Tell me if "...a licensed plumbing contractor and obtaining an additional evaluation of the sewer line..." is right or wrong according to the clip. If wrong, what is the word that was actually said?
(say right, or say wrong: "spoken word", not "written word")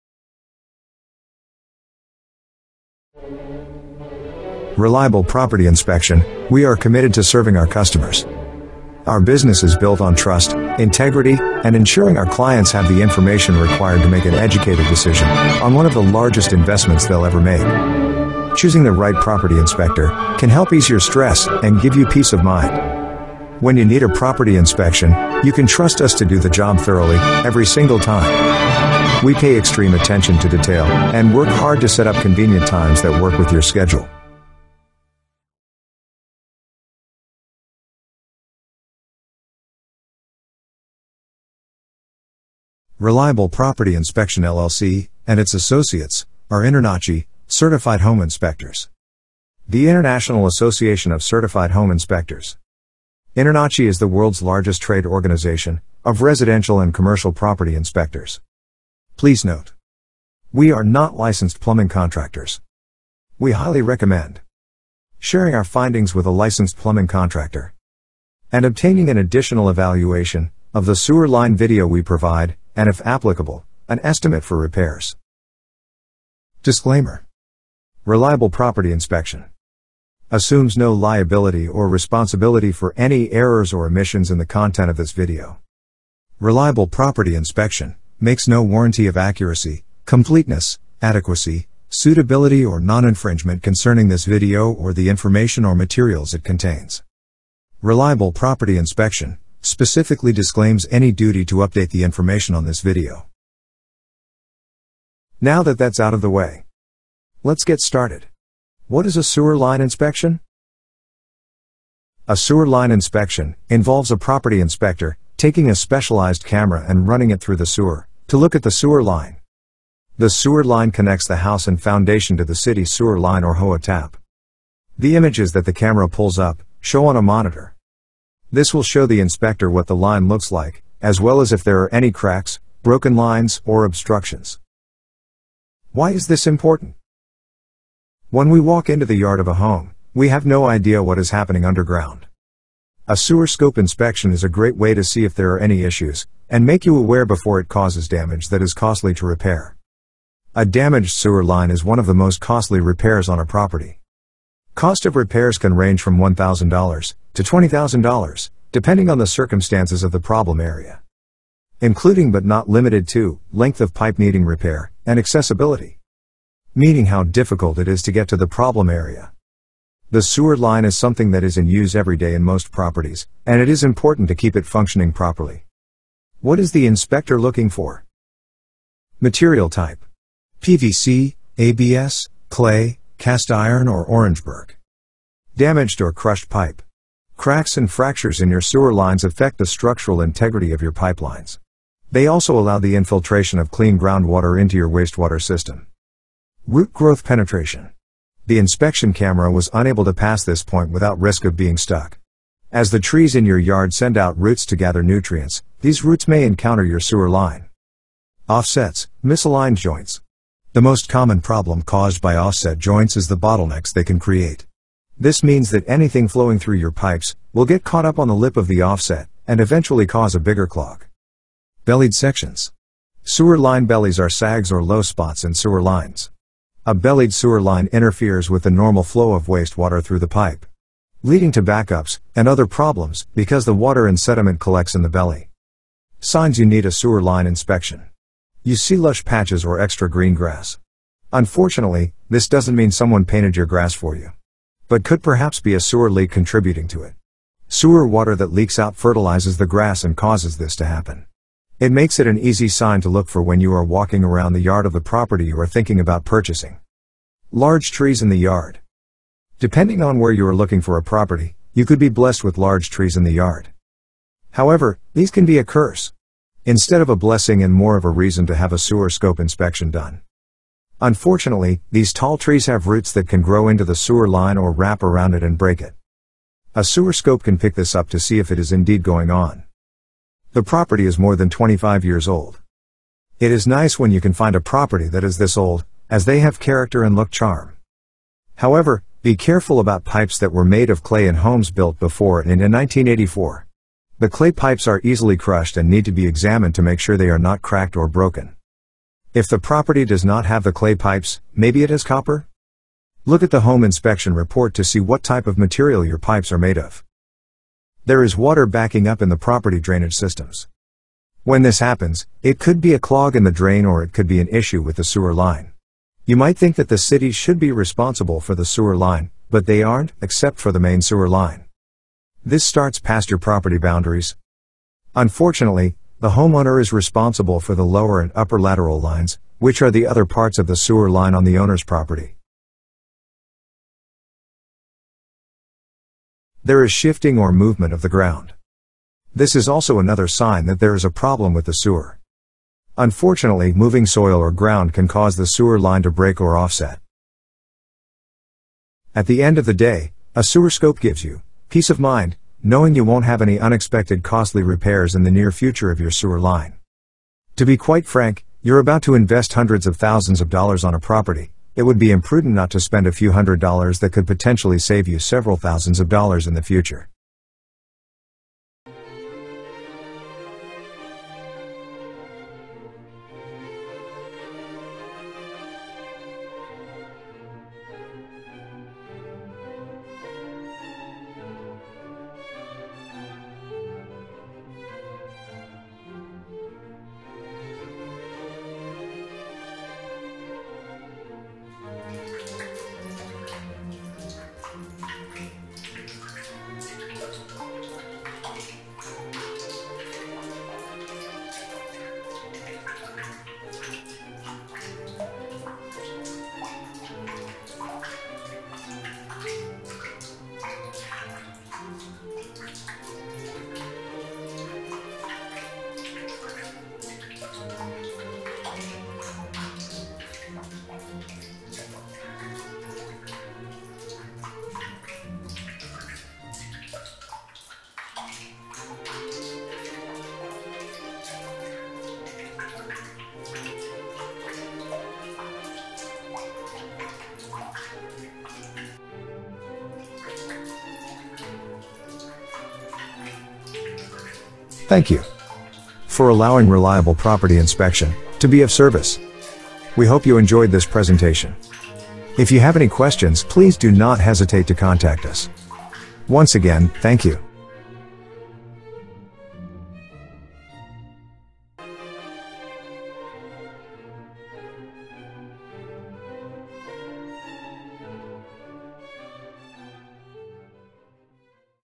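right.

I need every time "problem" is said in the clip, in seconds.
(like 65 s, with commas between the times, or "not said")
160 s, 168 s, 211 s, 232 s, 341 s.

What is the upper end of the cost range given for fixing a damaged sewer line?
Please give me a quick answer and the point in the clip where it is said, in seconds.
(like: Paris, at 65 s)
$20,000, at 157 s.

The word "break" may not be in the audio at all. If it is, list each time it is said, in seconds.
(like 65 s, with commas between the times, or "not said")
275 s, 346 s.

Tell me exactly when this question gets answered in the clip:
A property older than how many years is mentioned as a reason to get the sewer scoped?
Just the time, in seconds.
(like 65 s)
281 s.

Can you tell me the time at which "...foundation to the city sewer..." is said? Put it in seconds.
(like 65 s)
121 s.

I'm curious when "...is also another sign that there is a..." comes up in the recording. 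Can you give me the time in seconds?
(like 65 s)
339 s.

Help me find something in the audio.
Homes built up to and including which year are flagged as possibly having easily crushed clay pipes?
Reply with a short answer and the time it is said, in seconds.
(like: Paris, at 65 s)
1984, at 292 s.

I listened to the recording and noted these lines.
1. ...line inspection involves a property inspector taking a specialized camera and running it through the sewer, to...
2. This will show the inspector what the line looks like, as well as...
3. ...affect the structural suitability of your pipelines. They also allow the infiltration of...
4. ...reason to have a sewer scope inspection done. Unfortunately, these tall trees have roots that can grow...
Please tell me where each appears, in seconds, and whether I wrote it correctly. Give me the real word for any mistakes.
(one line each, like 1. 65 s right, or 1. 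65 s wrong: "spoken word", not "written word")
1. 112 s right
2. 128 s right
3. 189 s wrong: "integrity", not "suitability"
4. 268 s right.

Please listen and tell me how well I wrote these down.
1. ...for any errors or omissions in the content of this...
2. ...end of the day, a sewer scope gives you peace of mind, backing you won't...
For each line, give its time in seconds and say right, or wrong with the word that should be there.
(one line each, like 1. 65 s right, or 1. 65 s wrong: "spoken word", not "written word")
1. 82 s right
2. 349 s wrong: "knowing", not "backing".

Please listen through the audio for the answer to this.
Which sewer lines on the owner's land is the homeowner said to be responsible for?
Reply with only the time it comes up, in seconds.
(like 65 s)
327 s.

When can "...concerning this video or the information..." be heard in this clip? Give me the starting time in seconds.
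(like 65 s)
93 s.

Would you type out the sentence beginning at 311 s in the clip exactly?
When this happens, it could be a clog in the drain or it could be an issue with the sewer line.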